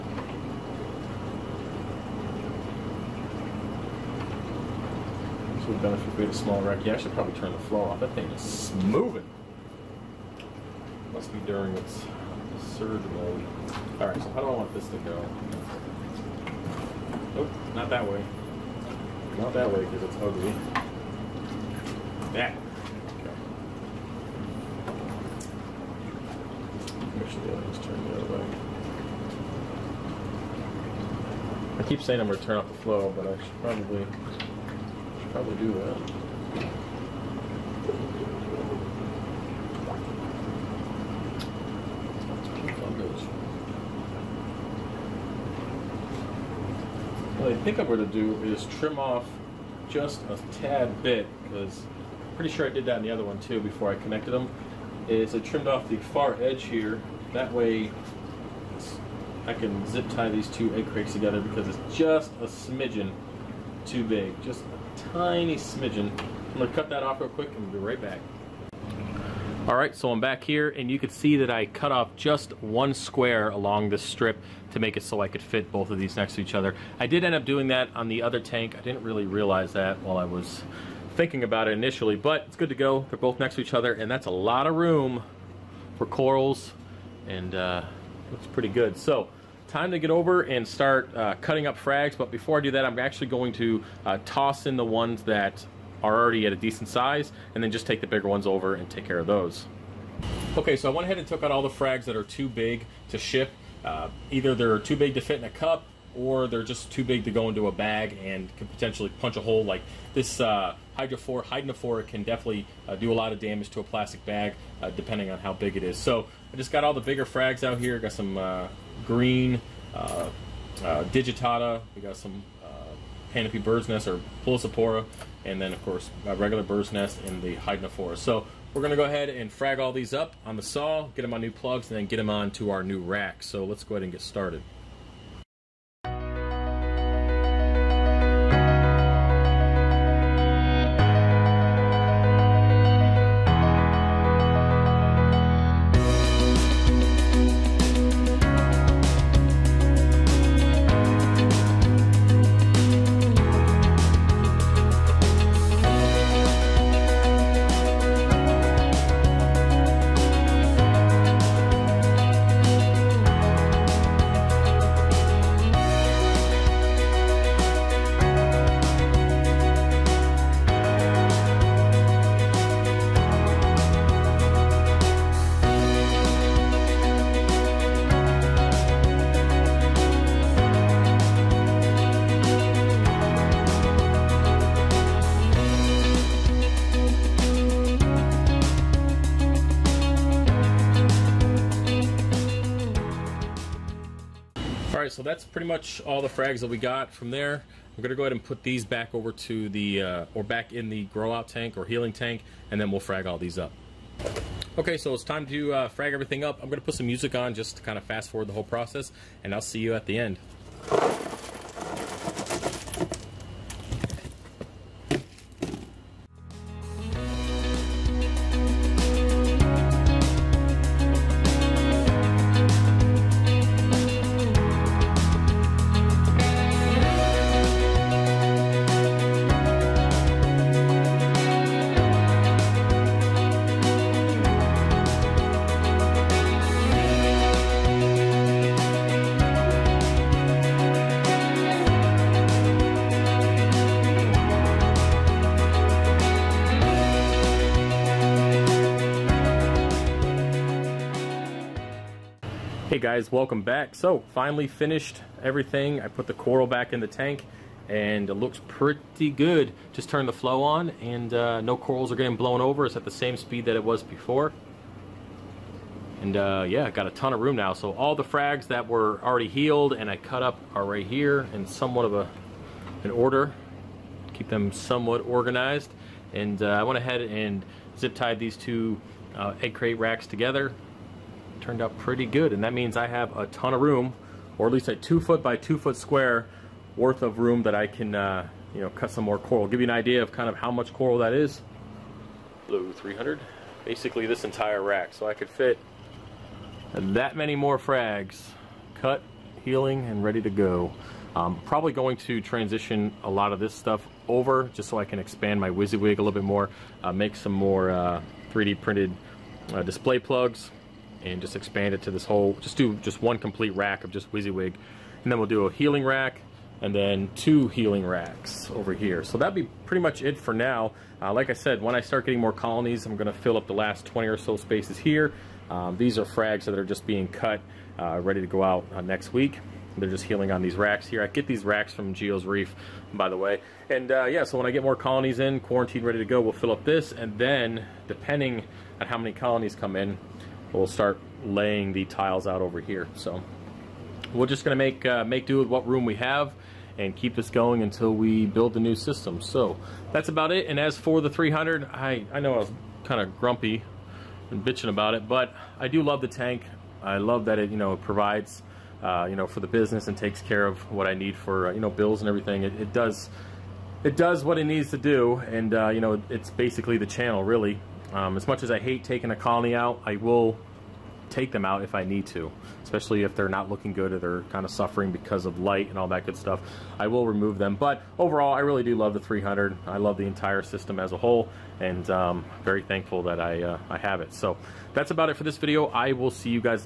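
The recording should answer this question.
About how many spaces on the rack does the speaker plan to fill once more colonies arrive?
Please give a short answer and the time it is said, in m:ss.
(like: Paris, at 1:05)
20, at 5:24.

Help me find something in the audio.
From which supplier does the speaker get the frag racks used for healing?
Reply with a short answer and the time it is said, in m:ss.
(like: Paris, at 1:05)
Geo's Reef, at 5:32.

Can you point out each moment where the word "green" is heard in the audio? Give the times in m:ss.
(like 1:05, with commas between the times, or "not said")
1:59.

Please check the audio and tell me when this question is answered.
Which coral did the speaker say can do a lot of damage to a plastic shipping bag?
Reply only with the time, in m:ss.
1:50.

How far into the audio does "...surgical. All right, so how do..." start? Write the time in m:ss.
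0:12.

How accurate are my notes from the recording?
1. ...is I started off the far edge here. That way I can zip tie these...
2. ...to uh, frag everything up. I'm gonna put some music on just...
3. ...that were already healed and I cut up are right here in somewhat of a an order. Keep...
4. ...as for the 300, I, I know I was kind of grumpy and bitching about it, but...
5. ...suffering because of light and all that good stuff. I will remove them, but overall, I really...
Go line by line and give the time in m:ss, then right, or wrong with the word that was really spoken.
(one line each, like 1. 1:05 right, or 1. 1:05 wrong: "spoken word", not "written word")
1. 0:55 wrong: "trimmed", not "started"
2. 3:25 right
3. 4:28 right
4. 5:50 right
5. 6:14 right.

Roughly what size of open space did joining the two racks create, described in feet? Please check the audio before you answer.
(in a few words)
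2 feet by 2 feet.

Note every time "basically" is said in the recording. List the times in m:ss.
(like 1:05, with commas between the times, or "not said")
4:53, 6:06.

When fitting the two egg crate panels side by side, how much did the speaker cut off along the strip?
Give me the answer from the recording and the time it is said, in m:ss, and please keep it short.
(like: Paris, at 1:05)
one square, at 1:12.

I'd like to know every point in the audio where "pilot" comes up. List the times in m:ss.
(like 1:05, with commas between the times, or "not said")
not said.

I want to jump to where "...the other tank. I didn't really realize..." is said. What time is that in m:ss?
1:18.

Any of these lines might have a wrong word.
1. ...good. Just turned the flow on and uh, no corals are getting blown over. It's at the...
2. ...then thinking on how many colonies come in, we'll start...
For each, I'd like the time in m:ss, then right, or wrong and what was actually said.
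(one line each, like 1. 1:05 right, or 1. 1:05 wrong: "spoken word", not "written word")
1. 4:19 right
2. 5:37 wrong: "depending", not "thinking".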